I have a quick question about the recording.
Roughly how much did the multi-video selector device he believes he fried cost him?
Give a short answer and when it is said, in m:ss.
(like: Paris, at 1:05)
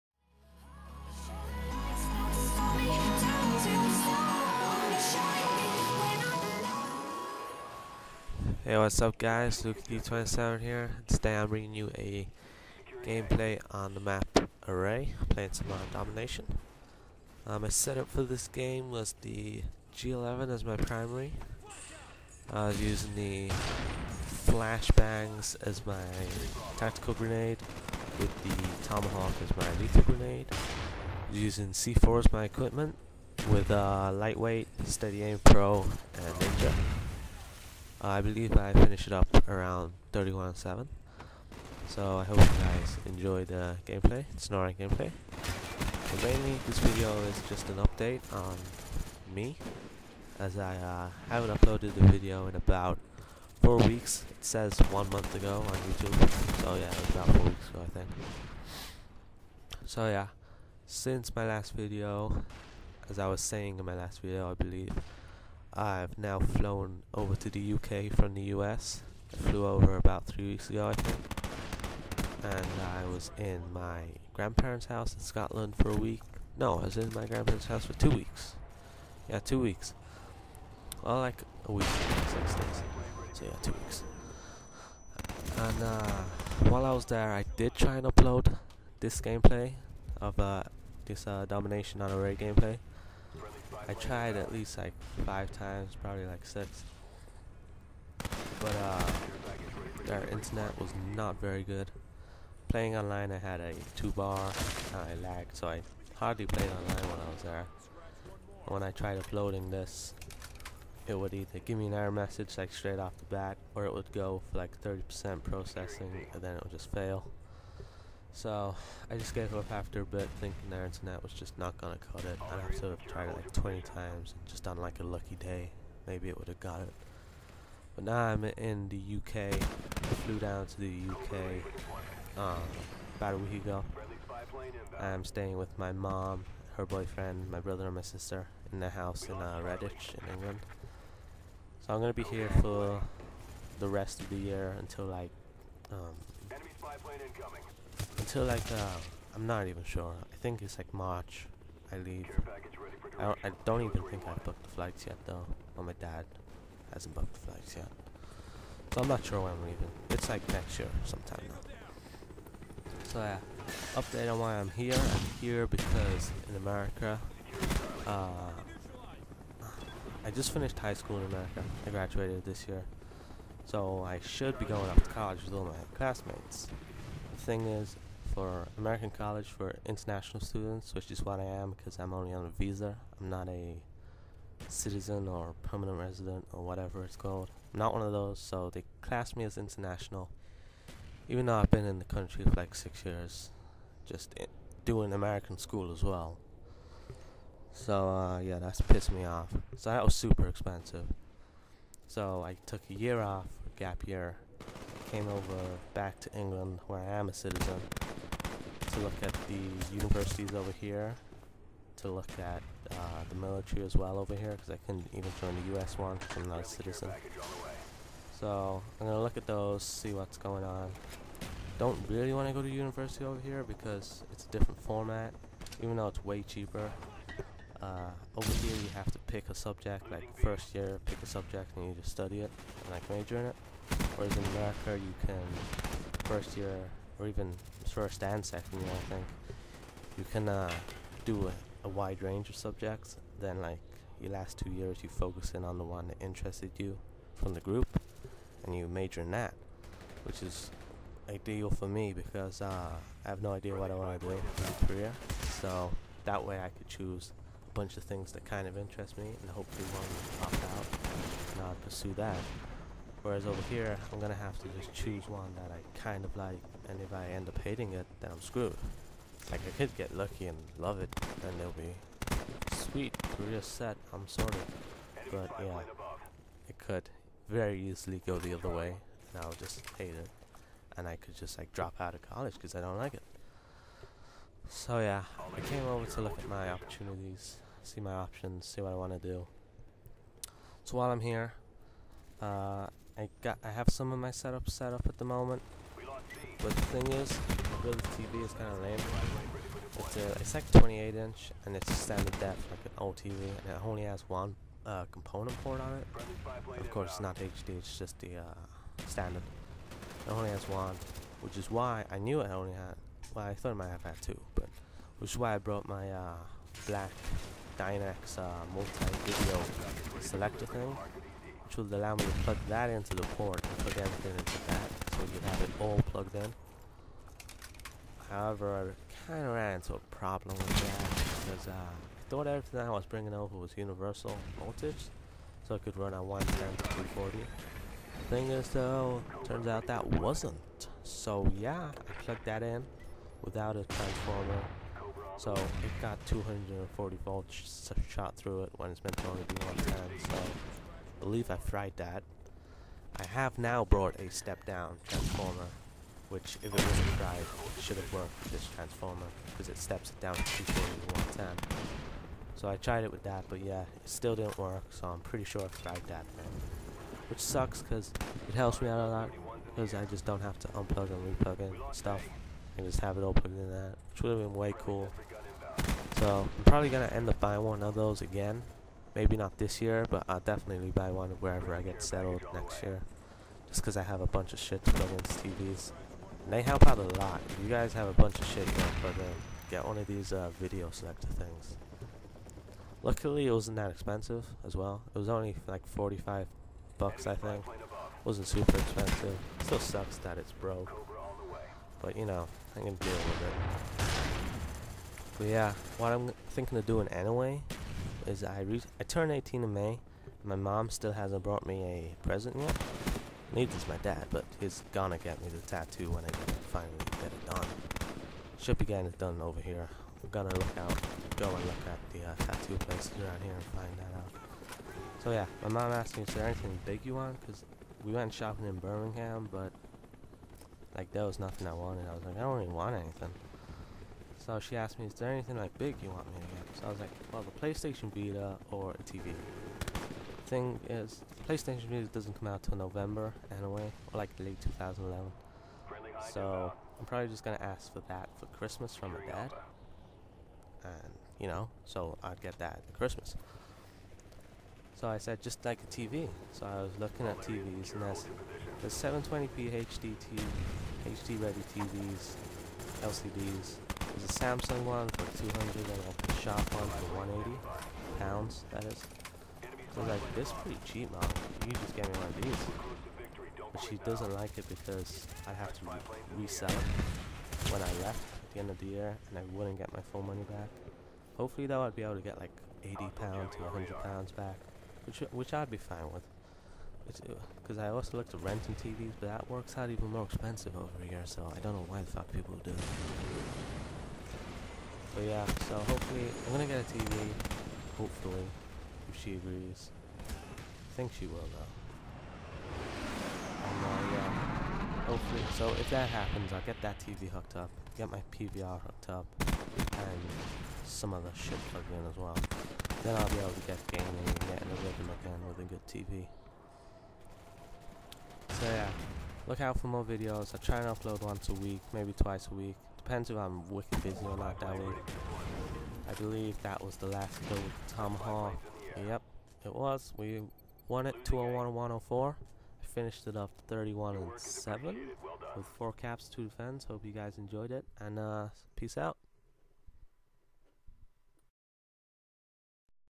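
45 bucks, at 6:35.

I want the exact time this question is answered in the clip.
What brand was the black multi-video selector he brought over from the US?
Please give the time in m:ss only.
5:17.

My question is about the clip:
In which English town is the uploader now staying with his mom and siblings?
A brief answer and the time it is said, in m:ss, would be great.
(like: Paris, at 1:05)
Redditch, at 2:19.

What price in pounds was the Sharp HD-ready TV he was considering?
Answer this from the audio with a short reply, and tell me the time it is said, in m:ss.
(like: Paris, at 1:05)
180 pounds, at 7:47.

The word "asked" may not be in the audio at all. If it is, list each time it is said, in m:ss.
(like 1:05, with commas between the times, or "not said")
7:05, 7:14.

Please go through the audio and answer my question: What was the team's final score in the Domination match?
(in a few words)
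201-104.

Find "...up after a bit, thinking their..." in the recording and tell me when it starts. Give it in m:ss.
1:59.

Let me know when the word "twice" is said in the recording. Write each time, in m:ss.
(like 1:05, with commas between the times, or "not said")
8:42.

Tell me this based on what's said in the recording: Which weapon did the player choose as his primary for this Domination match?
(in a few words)
G11.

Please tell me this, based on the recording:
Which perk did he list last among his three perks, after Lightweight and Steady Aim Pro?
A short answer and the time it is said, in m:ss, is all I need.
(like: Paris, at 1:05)
Ninja, at 0:36.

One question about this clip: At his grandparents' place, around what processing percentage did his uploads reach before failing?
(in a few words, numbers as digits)
30%.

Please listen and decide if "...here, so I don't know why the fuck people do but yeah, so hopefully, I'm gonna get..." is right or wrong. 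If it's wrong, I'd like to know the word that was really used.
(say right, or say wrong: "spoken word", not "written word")
right.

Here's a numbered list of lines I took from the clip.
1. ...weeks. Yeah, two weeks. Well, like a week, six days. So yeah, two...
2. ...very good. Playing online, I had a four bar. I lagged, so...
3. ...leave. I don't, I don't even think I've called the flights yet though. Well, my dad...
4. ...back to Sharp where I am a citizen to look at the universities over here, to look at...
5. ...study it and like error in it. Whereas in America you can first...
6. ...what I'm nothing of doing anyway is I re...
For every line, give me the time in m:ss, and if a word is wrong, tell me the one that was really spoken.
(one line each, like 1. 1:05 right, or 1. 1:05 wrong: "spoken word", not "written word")
1. 1:18 right
2. 1:41 wrong: "two", not "four"
3. 2:31 wrong: "booked", not "called"
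4. 3:25 wrong: "England", not "Sharp"
5. 3:52 wrong: "major", not "error"
6. 6:45 wrong: "thinking", not "nothing".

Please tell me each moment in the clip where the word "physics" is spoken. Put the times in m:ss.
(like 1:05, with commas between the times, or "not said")
not said.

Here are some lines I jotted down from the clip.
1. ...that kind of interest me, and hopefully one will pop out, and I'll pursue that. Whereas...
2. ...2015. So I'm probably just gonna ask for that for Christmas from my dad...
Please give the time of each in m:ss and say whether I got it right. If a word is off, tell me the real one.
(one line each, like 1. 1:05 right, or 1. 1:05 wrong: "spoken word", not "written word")
1. 4:18 right
2. 7:24 wrong: "2011", not "2015".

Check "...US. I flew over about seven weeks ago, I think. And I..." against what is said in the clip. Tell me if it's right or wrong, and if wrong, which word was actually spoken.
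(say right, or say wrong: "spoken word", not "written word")
wrong: "three", not "seven".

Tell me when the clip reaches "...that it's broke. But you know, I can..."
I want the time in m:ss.
6:40.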